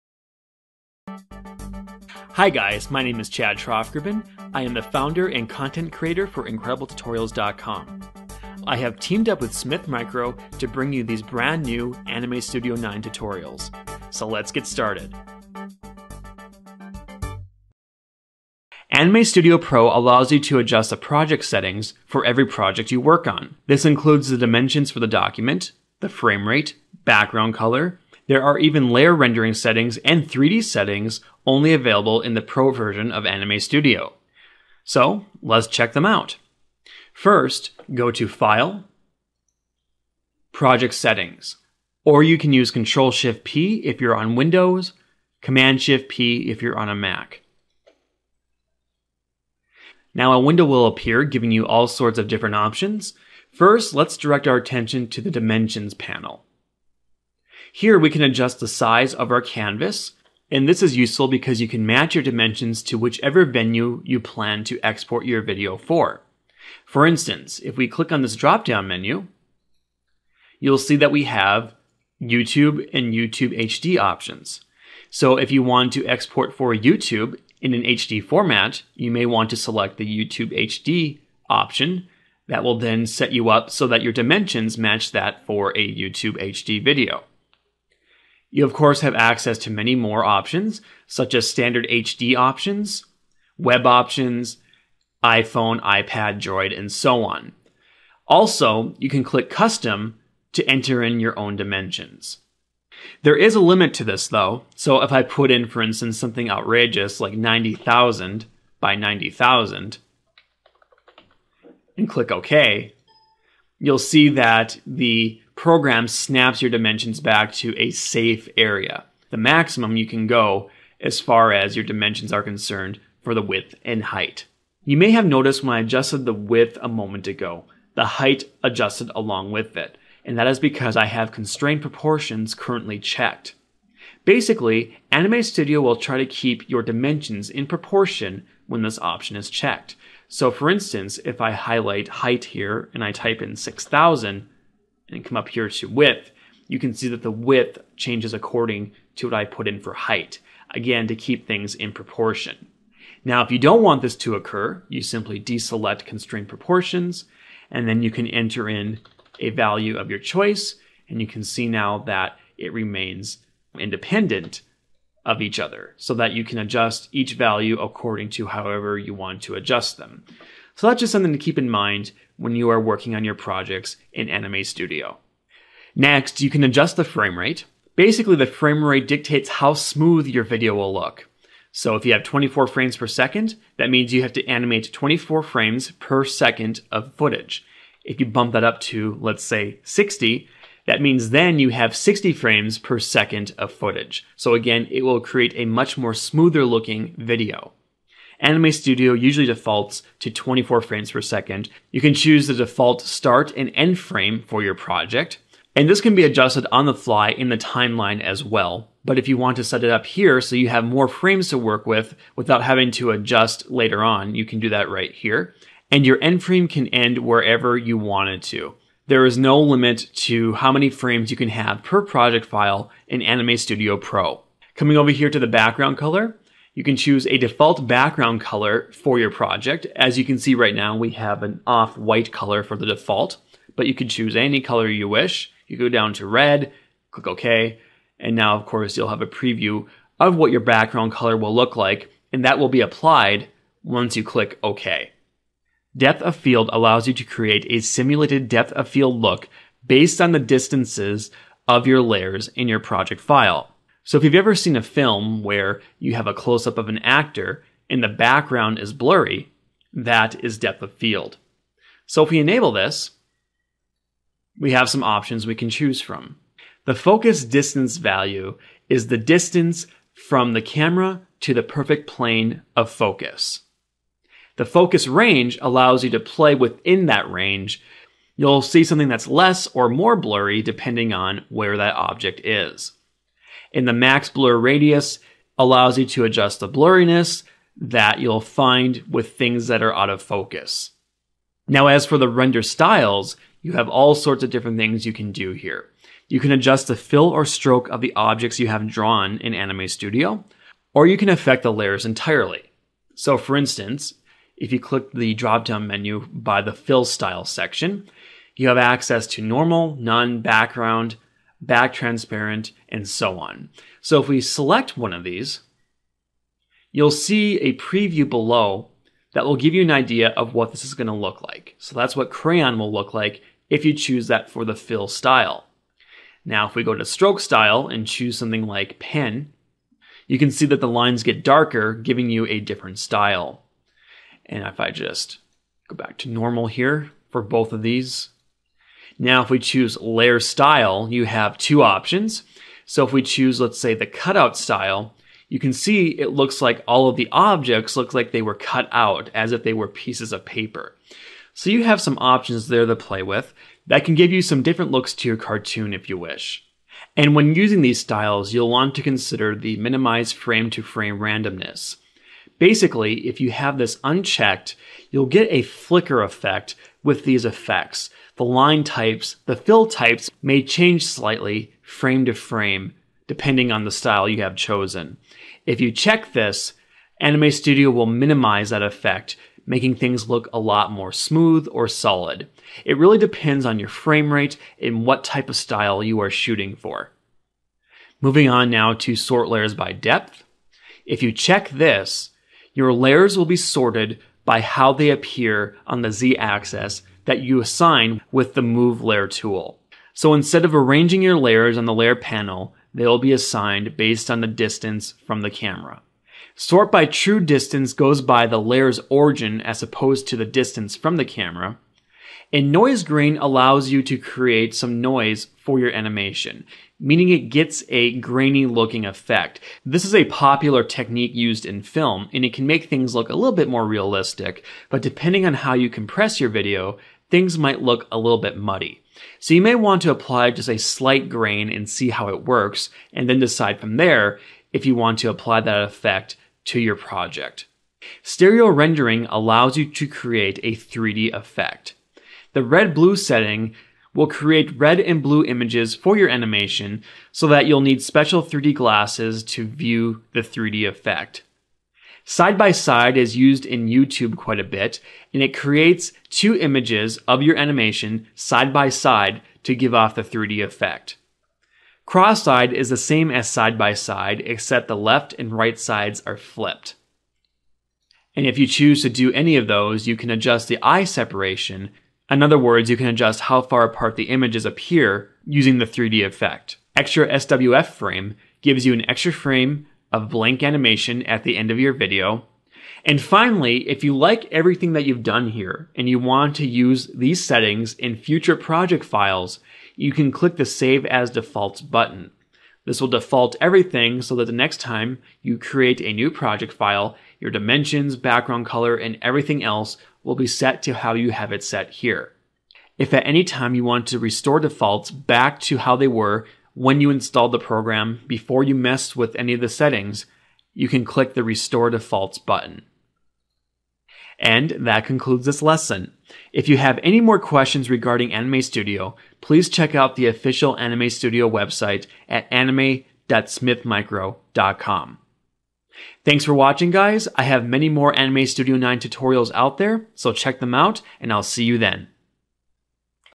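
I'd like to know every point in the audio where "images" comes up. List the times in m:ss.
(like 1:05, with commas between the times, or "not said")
7:25, 7:36, 7:54.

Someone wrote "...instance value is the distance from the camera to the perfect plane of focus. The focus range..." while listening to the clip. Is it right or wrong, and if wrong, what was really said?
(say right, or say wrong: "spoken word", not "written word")
wrong: "distance", not "instance".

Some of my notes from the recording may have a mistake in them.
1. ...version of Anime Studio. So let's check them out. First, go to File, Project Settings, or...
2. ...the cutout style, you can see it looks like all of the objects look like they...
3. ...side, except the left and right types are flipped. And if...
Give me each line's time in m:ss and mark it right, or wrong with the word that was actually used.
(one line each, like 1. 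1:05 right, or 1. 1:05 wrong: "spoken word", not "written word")
1. 0:32 right
2. 5:43 right
3. 7:43 wrong: "sides", not "types".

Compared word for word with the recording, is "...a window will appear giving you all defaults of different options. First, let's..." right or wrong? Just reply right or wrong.
wrong.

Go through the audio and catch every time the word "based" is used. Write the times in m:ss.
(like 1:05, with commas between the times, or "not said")
4:09, 6:43.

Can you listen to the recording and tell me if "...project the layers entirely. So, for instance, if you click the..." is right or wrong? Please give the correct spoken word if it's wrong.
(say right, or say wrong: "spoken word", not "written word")
wrong: "affect", not "project".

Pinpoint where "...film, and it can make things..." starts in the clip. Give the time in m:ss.
7:01.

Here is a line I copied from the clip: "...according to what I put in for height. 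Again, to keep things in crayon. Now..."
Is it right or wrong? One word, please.
wrong.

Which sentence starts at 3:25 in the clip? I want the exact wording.
And this can be adjusted on the fly in the timeline as well.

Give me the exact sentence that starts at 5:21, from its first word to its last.
So that's what crayon will look like if you choose that for the fill style.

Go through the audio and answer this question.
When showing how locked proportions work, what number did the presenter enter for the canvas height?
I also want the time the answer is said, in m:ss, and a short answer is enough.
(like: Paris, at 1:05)
6000, at 2:23.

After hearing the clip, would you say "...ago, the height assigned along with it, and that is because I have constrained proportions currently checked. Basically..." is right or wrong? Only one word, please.
wrong.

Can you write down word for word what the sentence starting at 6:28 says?
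Moving on now to sort layers by depth.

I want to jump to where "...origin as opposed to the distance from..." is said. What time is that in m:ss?
6:49.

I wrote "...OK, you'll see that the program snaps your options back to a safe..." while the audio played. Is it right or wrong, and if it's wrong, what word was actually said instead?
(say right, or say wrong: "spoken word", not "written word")
wrong: "dimensions", not "options".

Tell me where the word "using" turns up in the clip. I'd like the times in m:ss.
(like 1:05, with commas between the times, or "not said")
5:57, 7:55.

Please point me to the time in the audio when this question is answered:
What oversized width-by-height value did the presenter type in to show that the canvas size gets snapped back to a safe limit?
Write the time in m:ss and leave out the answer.
1:47.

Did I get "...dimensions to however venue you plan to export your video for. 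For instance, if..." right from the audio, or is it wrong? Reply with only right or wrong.
wrong.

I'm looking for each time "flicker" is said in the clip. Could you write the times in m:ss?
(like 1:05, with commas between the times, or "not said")
6:05.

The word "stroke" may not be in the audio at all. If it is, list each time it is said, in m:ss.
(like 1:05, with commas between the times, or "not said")
4:57, 5:27.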